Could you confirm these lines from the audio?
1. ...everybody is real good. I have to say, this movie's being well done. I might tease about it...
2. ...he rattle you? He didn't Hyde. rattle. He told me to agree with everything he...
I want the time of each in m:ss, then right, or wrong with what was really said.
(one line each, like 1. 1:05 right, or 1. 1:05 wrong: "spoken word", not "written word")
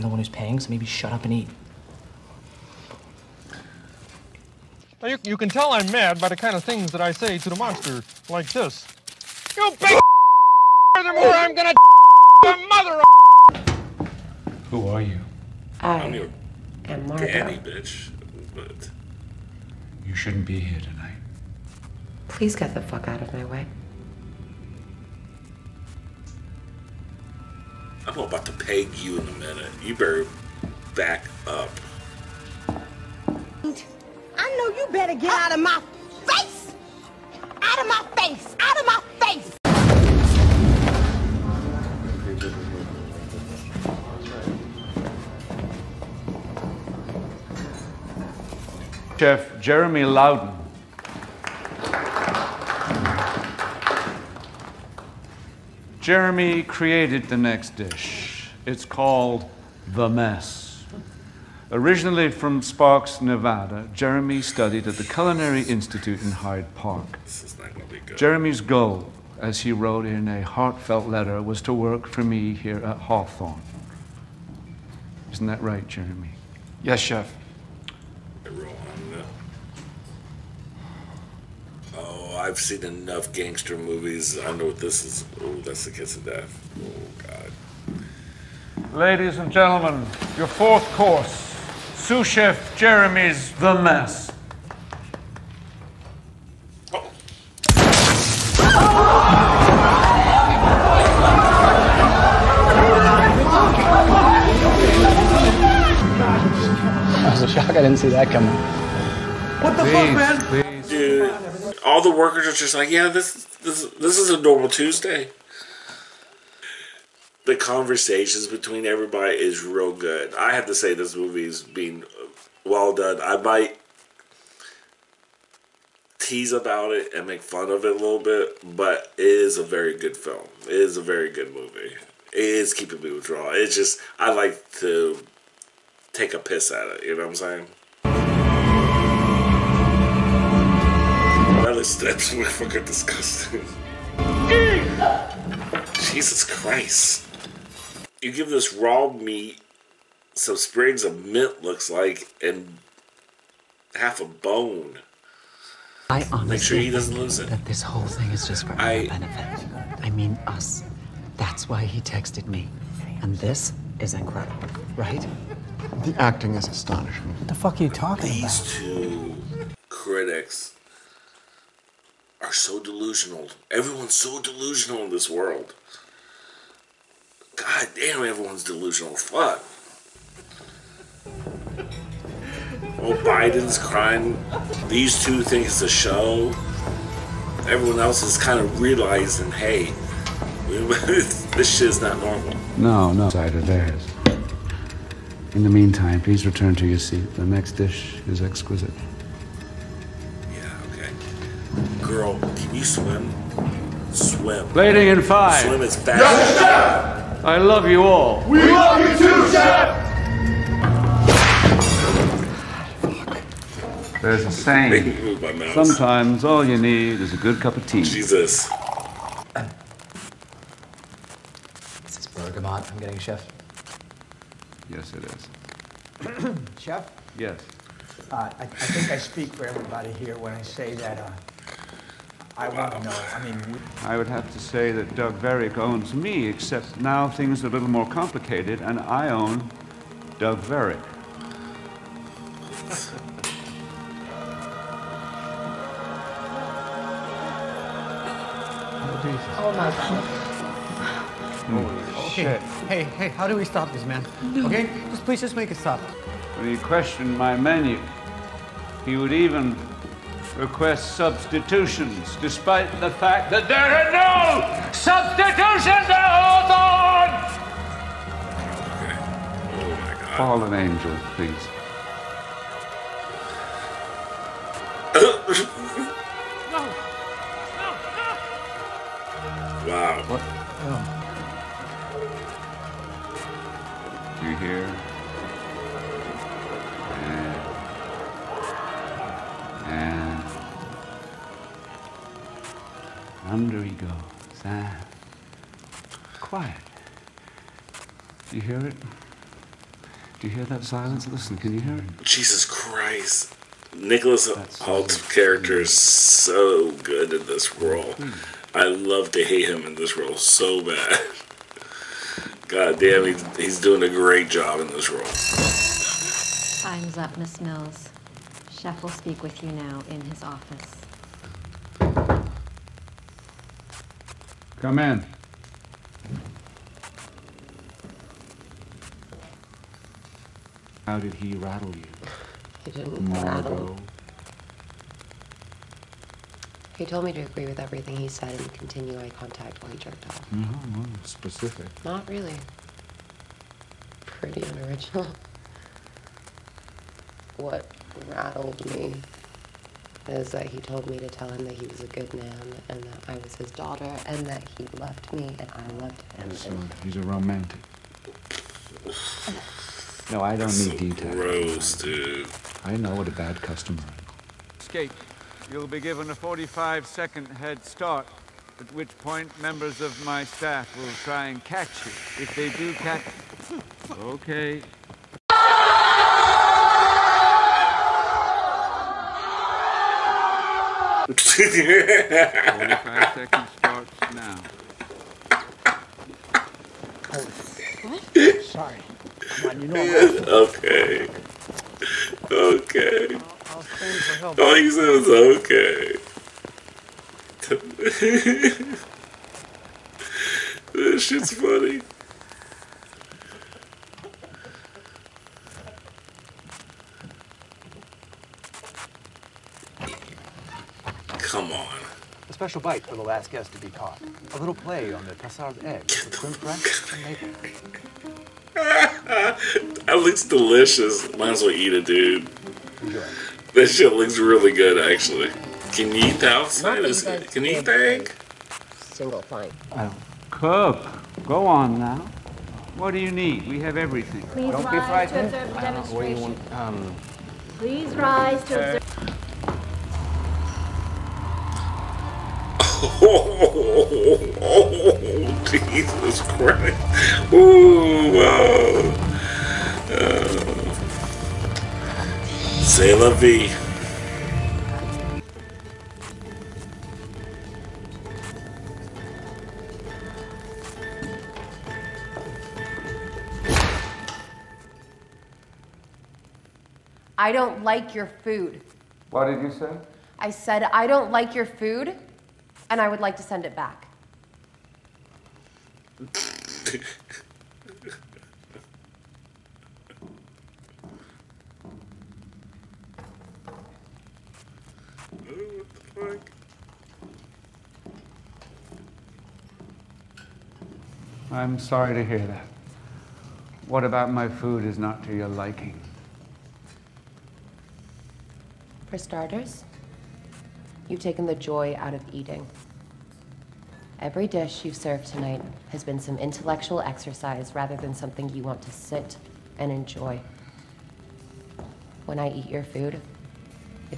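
1. 1:58 right
2. 5:31 wrong: "Margot", not "Hyde".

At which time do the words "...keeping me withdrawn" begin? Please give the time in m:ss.
2:12.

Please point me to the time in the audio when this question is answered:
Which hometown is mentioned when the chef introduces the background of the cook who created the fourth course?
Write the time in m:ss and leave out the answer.
1:02.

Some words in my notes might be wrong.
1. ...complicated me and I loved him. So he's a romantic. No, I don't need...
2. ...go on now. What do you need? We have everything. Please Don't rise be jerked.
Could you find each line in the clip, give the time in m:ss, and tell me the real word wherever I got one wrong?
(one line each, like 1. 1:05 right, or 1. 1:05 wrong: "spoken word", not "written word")
1. 5:54 wrong: "loved", not "complicated"
2. 7:11 wrong: "frightened", not "jerked".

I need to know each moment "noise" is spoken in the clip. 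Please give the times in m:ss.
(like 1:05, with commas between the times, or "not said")
not said.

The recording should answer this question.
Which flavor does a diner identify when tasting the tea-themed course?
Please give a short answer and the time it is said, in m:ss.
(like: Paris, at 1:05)
Bergamot, at 3:42.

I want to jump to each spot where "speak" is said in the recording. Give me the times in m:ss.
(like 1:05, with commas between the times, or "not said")
3:49, 5:19.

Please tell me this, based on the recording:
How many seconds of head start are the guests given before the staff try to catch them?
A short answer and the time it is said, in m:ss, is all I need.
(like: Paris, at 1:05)
45, at 6:06.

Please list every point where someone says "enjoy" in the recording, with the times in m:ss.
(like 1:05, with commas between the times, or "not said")
7:03, 8:29.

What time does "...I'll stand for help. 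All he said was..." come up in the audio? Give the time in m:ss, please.
6:33.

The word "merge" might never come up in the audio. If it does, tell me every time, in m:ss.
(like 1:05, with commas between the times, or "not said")
not said.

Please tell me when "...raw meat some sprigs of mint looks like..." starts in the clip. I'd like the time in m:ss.
2:28.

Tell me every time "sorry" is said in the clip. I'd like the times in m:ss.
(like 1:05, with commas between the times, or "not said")
6:28, 8:11.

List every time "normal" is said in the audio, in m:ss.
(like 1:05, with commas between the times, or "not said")
1:54, 3:12.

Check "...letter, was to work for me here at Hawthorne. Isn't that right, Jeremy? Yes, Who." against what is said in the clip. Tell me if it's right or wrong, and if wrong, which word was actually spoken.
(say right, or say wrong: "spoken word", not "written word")
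wrong: "Chef", not "Who".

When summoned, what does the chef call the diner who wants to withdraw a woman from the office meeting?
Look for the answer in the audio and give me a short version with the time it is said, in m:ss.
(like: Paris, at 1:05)
Miss Mills, at 5:17.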